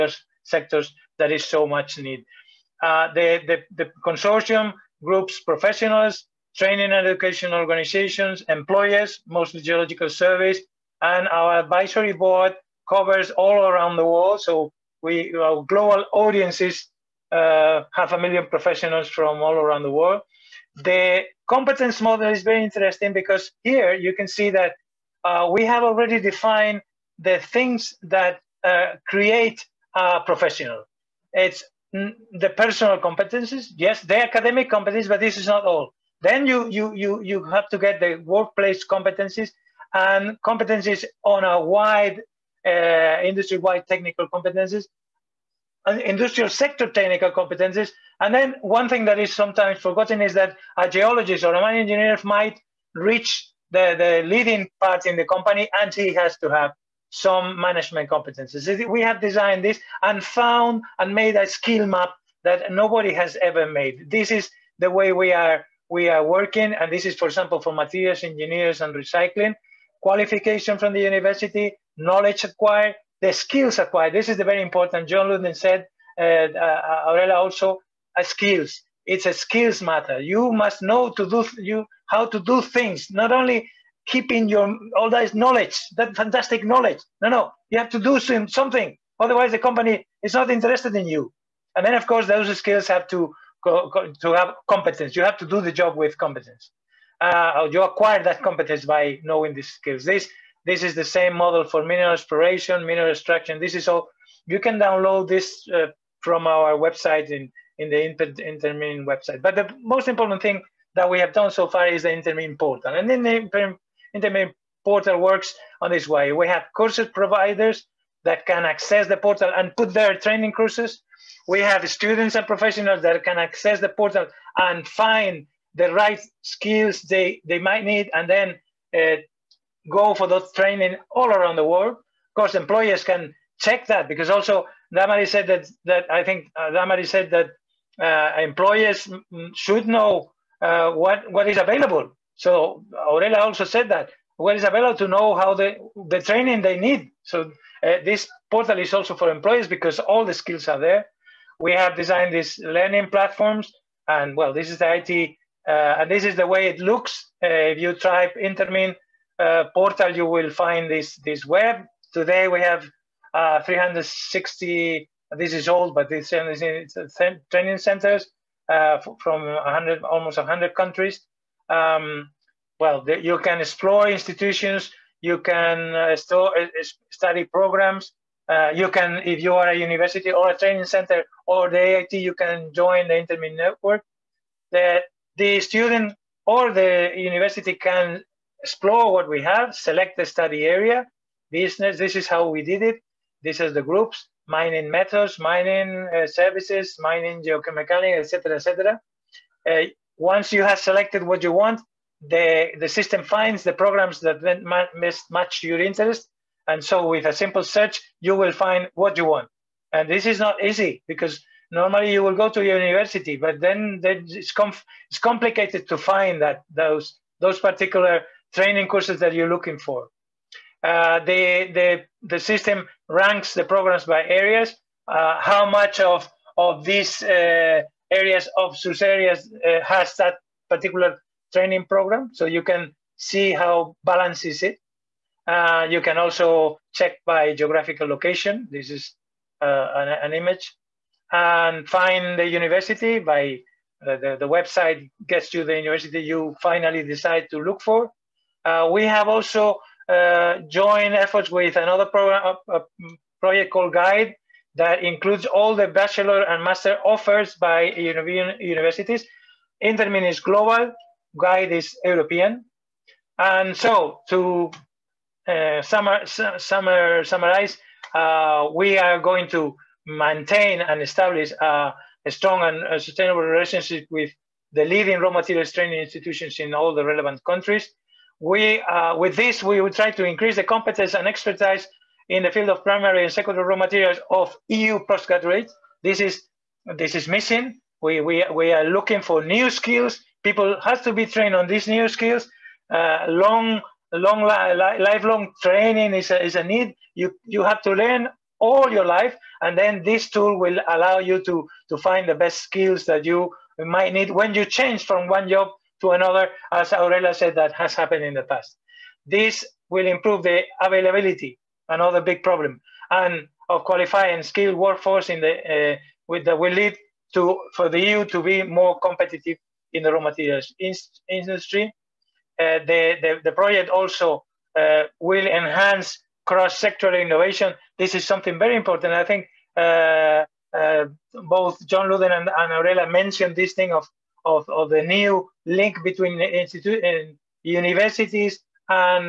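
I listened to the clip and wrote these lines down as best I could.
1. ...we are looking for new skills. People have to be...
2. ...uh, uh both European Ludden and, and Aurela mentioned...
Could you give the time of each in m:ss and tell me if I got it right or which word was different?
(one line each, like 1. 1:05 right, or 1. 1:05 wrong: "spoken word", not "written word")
1. 4:48 right
2. 5:29 wrong: "John", not "European".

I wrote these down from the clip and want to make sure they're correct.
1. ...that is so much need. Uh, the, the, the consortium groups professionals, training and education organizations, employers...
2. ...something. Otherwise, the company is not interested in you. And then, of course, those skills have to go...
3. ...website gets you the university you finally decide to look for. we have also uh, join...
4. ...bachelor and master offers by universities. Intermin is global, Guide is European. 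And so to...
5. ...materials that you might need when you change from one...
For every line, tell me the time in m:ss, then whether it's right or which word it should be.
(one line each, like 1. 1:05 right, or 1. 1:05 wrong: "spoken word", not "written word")
1. 0:01 right
2. 1:28 right
3. 4:04 right
4. 4:15 right
5. 5:02 wrong: "skills", not "materials".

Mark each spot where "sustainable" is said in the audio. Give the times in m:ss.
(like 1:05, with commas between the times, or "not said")
4:32.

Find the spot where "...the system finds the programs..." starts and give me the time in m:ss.
3:22.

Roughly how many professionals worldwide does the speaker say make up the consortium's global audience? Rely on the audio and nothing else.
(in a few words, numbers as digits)
half a million.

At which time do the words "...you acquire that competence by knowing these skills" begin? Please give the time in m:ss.
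1:37.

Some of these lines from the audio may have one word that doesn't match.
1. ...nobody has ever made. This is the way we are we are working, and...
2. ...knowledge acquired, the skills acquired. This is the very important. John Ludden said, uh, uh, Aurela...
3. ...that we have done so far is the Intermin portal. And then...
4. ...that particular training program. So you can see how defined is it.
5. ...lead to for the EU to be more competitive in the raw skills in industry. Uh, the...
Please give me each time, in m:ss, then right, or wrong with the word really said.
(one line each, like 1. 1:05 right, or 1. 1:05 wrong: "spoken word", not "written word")
1. 1:02 right
2. 1:11 right
3. 1:50 right
4. 3:50 wrong: "balanced", not "defined"
5. 5:16 wrong: "materials", not "skills".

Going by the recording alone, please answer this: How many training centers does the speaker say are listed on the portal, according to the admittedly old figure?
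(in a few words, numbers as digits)
360.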